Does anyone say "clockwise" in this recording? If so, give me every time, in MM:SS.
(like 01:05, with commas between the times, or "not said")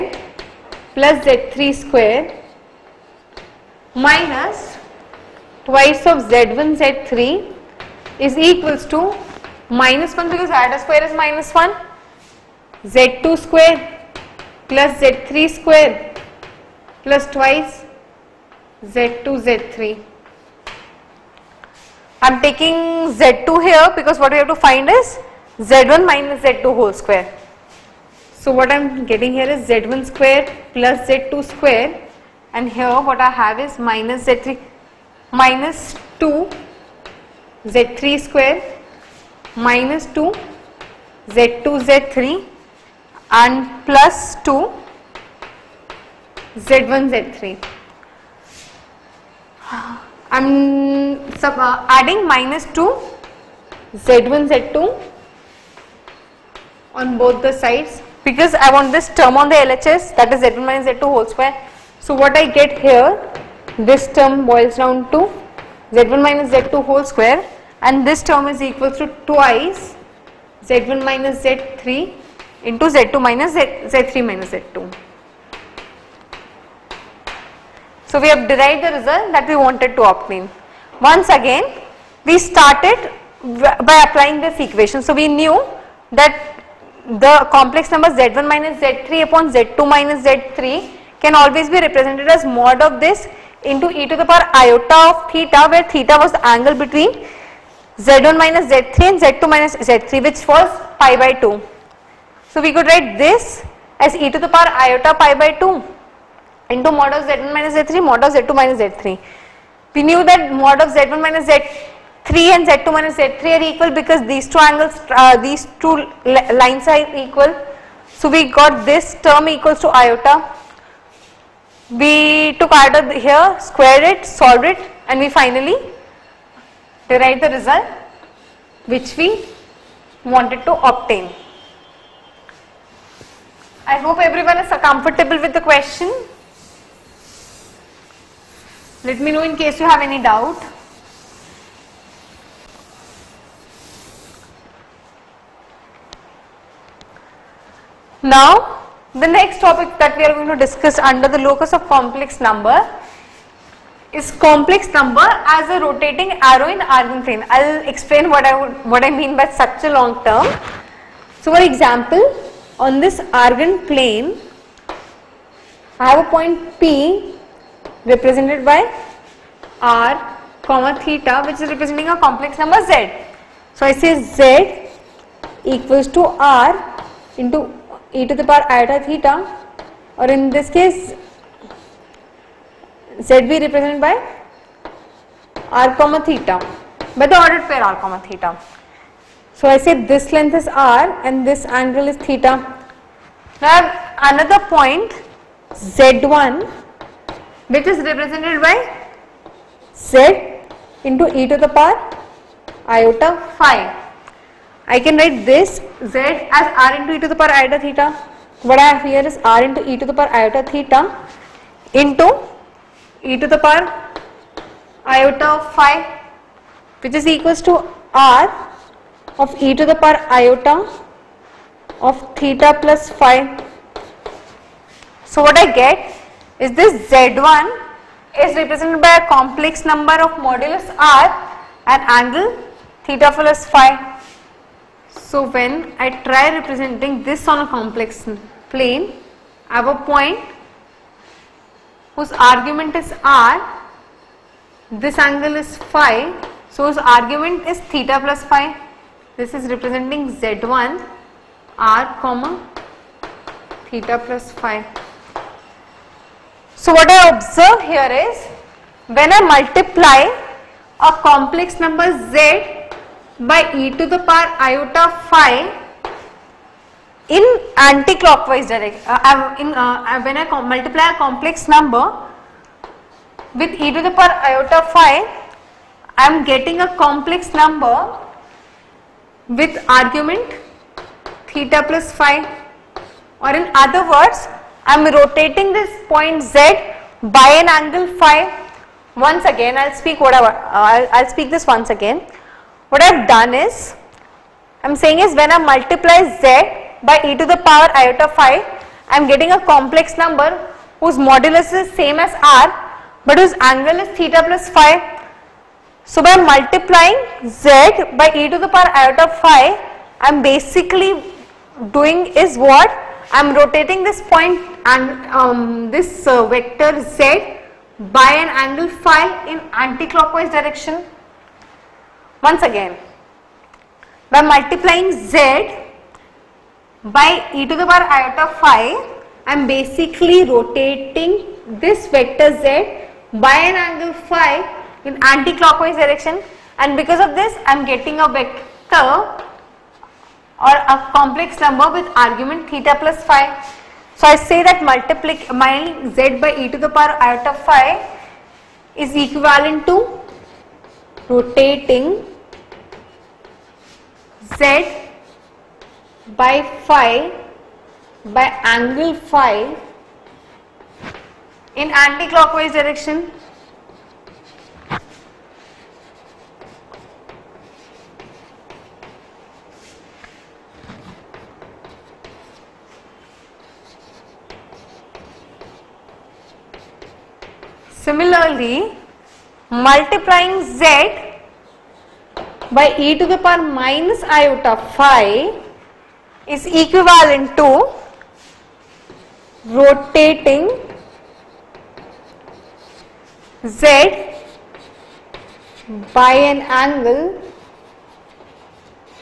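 04:27, 05:19, 05:35, 06:02.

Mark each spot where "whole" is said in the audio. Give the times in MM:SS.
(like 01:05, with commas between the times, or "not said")
00:26, 01:01, 01:06.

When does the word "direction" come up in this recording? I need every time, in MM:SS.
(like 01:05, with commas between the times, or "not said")
04:28, 05:20, 05:35, 06:02.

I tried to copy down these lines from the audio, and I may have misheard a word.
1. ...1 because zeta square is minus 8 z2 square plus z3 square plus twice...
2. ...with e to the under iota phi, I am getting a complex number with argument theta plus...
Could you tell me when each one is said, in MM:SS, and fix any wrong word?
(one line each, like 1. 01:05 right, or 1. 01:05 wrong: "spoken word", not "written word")
1. 00:10 wrong: "1", not "8"
2. 04:33 wrong: "power", not "under".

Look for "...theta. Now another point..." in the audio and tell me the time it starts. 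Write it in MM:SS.
03:12.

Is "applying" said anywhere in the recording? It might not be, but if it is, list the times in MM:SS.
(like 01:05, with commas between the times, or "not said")
01:24.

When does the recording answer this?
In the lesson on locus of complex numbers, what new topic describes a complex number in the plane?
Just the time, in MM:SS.
02:35.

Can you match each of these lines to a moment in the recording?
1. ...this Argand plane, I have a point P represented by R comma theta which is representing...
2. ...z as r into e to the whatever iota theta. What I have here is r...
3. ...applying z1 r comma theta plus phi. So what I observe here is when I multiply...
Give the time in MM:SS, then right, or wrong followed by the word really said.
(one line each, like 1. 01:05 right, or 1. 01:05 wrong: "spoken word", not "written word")
1. 02:42 right
2. 03:26 wrong: "power", not "whatever"
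3. 04:09 wrong: "representing", not "applying".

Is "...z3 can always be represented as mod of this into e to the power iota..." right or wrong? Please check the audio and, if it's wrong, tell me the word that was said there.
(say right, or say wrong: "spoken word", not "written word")
right.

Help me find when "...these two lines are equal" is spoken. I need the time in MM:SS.
01:55.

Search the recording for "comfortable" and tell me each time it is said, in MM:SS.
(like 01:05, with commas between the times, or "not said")
02:14.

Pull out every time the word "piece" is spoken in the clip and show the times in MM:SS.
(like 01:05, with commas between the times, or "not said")
not said.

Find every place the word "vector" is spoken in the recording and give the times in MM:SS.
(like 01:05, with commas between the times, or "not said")
05:16, 05:32, 05:38.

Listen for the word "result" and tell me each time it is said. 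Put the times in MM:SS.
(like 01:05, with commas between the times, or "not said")
01:18, 02:07.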